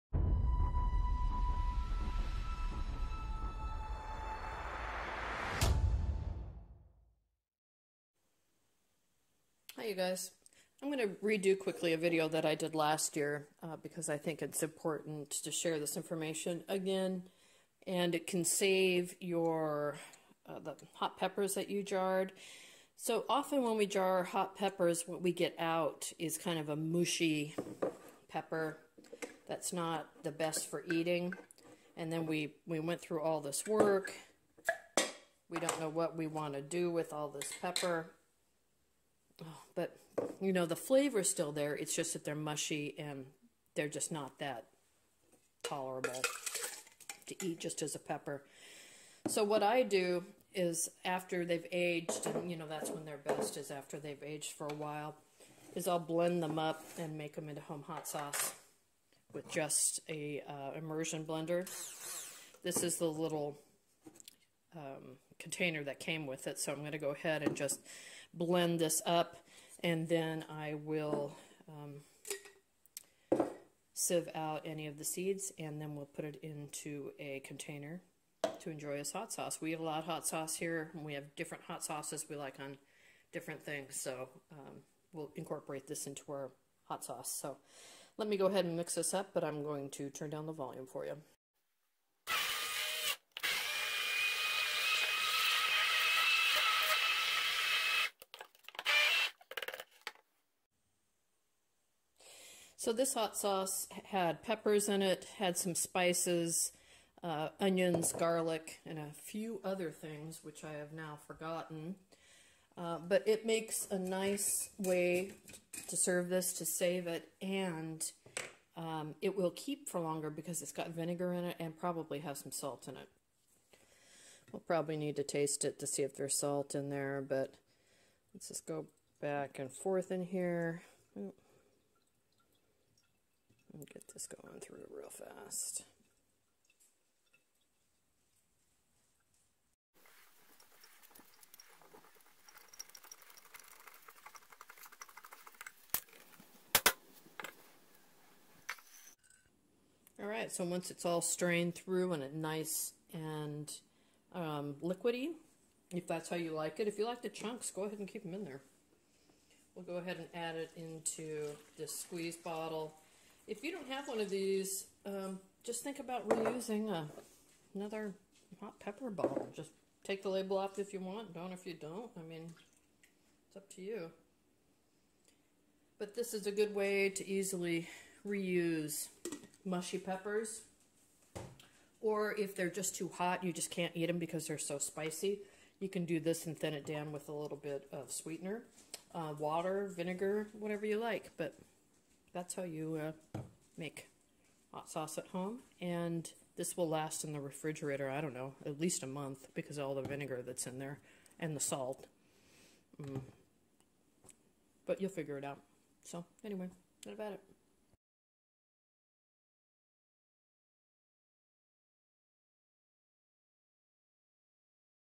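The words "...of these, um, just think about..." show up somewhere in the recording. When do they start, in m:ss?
2:44.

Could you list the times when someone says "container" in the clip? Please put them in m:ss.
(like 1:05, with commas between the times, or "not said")
1:05, 1:17.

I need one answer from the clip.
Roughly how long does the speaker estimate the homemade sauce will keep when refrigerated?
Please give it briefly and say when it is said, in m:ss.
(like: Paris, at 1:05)
At least a month, at 3:18.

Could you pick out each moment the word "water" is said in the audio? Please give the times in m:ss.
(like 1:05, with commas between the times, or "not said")
3:09.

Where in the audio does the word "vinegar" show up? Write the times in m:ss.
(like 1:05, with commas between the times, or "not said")
2:00, 3:09, 3:20.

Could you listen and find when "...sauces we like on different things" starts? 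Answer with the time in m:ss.
1:21.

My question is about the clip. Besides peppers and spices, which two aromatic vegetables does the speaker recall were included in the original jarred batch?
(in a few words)
Onions, garlic.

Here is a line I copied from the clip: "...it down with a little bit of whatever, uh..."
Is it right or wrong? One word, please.
wrong.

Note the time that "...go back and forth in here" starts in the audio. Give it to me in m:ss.
2:08.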